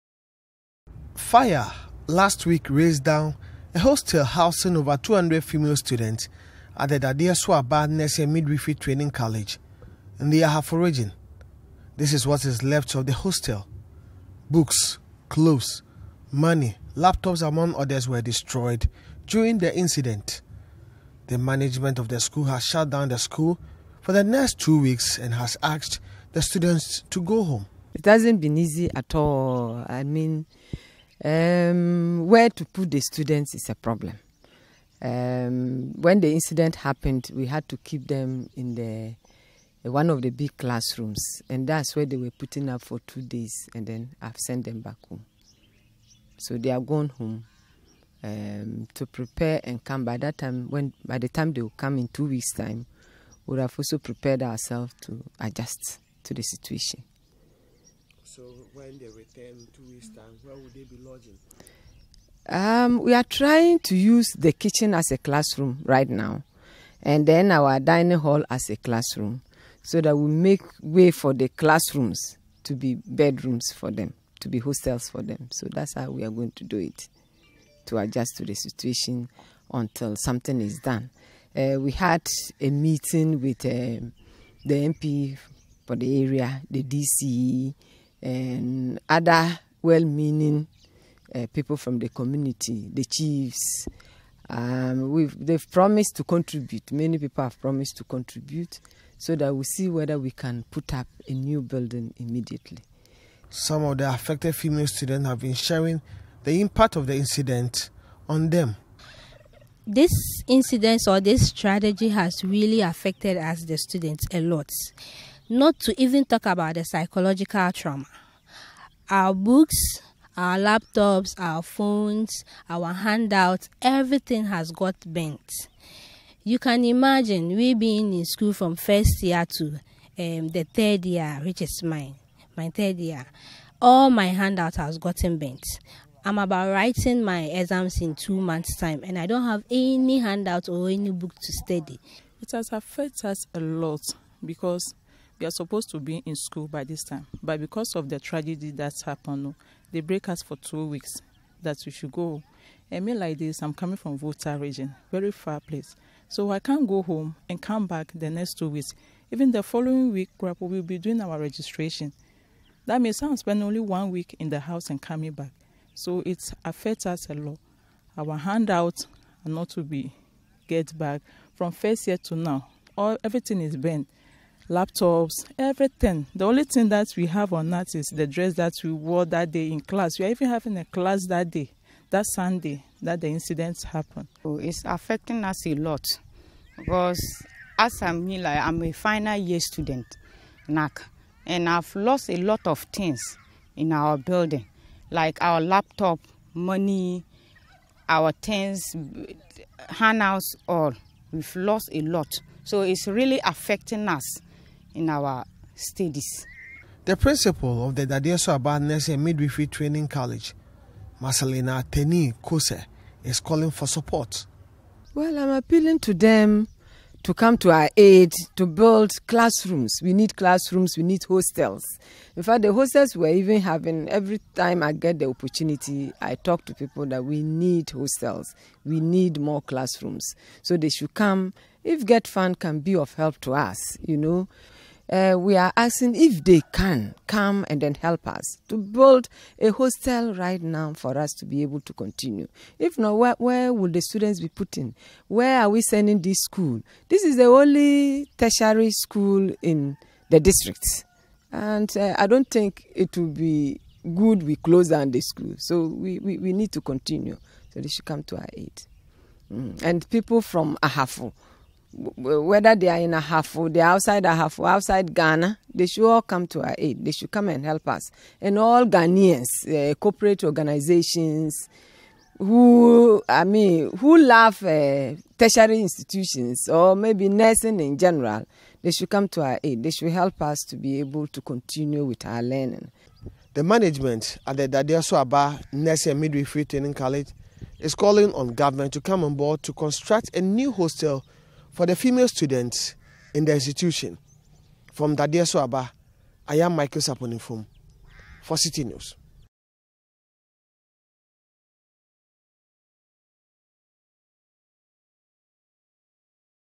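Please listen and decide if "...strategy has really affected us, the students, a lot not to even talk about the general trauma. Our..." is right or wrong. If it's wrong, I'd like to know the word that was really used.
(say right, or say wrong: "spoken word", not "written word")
wrong: "psychological", not "general".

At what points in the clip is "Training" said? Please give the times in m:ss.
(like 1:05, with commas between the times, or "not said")
0:08, 3:29, 4:46.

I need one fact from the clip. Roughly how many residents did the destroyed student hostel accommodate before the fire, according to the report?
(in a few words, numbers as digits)
over 200.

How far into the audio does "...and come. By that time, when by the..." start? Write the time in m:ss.
0:49.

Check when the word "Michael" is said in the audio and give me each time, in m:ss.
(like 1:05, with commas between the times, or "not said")
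4:56.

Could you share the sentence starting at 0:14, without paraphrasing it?
Books, clothes, money, laptops, among others, were destroyed during the incident.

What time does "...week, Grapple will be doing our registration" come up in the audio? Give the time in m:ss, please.
2:40.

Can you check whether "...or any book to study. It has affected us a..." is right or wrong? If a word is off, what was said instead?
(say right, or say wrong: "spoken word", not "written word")
right.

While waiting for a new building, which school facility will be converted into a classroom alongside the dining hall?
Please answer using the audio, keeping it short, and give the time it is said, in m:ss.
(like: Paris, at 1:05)
kitchen, at 1:04.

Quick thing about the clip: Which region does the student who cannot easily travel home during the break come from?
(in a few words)
Volta region.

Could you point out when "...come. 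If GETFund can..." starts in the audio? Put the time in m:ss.
3:51.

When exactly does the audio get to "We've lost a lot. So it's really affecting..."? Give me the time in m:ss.
3:21.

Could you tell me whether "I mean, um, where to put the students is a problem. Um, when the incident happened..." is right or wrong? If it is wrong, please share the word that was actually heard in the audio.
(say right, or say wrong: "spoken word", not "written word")
right.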